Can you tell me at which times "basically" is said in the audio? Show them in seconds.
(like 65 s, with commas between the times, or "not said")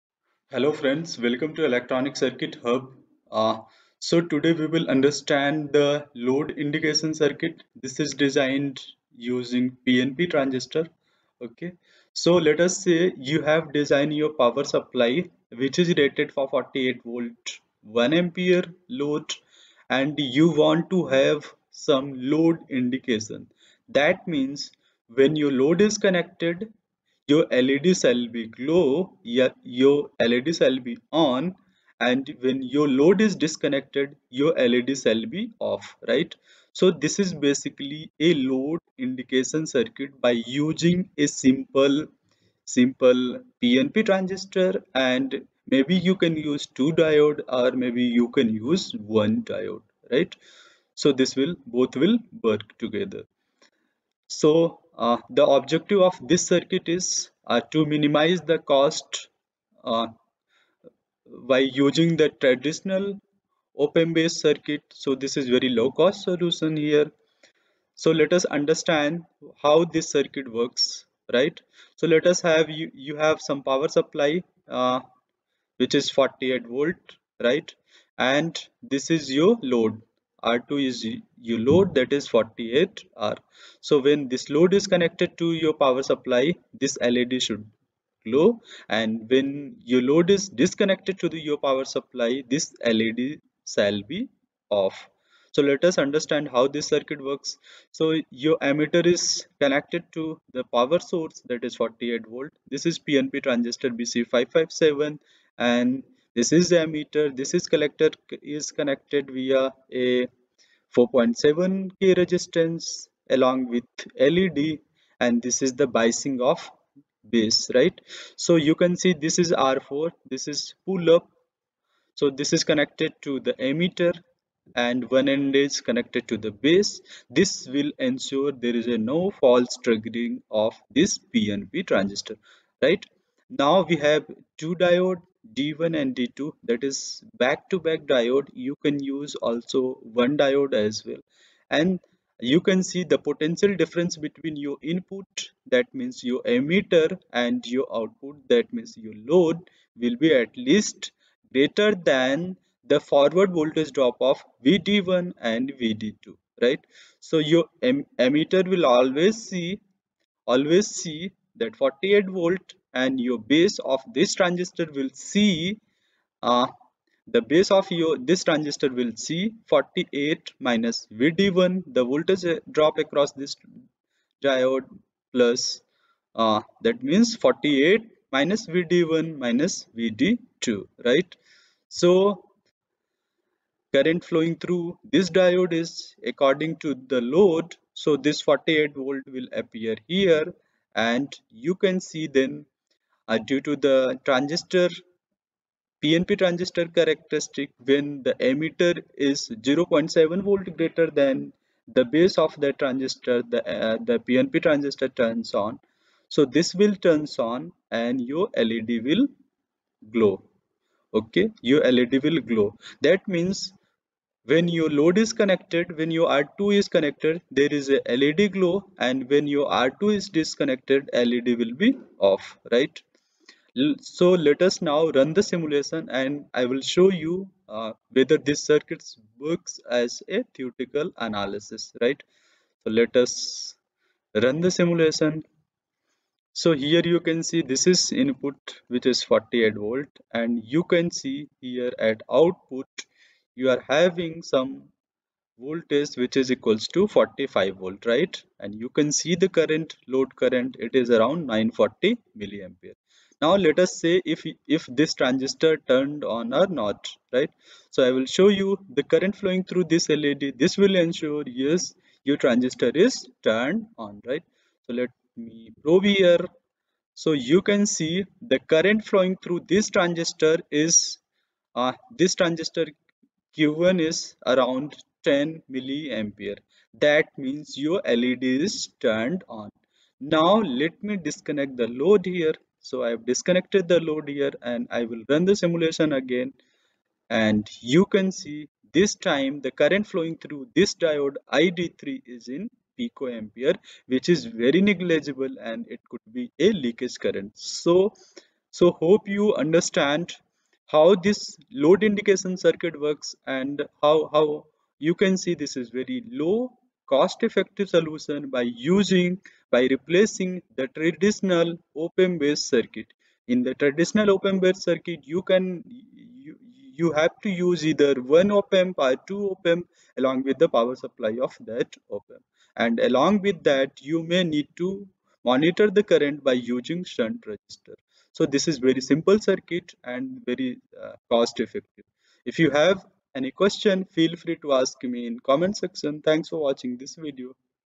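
37 s.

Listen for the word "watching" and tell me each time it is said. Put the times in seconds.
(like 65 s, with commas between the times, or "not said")
336 s.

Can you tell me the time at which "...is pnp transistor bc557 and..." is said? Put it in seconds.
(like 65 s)
102 s.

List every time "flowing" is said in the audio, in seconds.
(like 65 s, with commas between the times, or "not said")
184 s, 259 s, 269 s, 290 s.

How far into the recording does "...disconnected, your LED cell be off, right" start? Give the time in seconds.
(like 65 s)
33 s.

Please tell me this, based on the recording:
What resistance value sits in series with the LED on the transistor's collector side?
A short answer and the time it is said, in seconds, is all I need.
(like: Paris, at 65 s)
4.7k, at 110 s.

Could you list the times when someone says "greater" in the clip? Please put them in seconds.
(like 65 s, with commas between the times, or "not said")
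151 s, 200 s.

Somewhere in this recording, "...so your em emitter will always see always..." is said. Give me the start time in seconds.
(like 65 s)
157 s.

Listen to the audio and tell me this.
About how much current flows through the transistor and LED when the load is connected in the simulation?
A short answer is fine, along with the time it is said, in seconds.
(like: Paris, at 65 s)
10 milliamperes, at 275 s.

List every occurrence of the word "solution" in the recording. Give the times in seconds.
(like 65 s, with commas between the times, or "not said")
66 s, 307 s.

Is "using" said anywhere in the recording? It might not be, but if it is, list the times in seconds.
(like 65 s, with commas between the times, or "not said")
9 s, 40 s, 61 s, 308 s, 326 s.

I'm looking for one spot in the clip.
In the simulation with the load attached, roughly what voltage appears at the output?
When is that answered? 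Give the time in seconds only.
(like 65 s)
247 s.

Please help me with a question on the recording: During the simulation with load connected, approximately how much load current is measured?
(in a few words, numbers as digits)
940 milliamperes.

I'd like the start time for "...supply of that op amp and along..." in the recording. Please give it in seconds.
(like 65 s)
321 s.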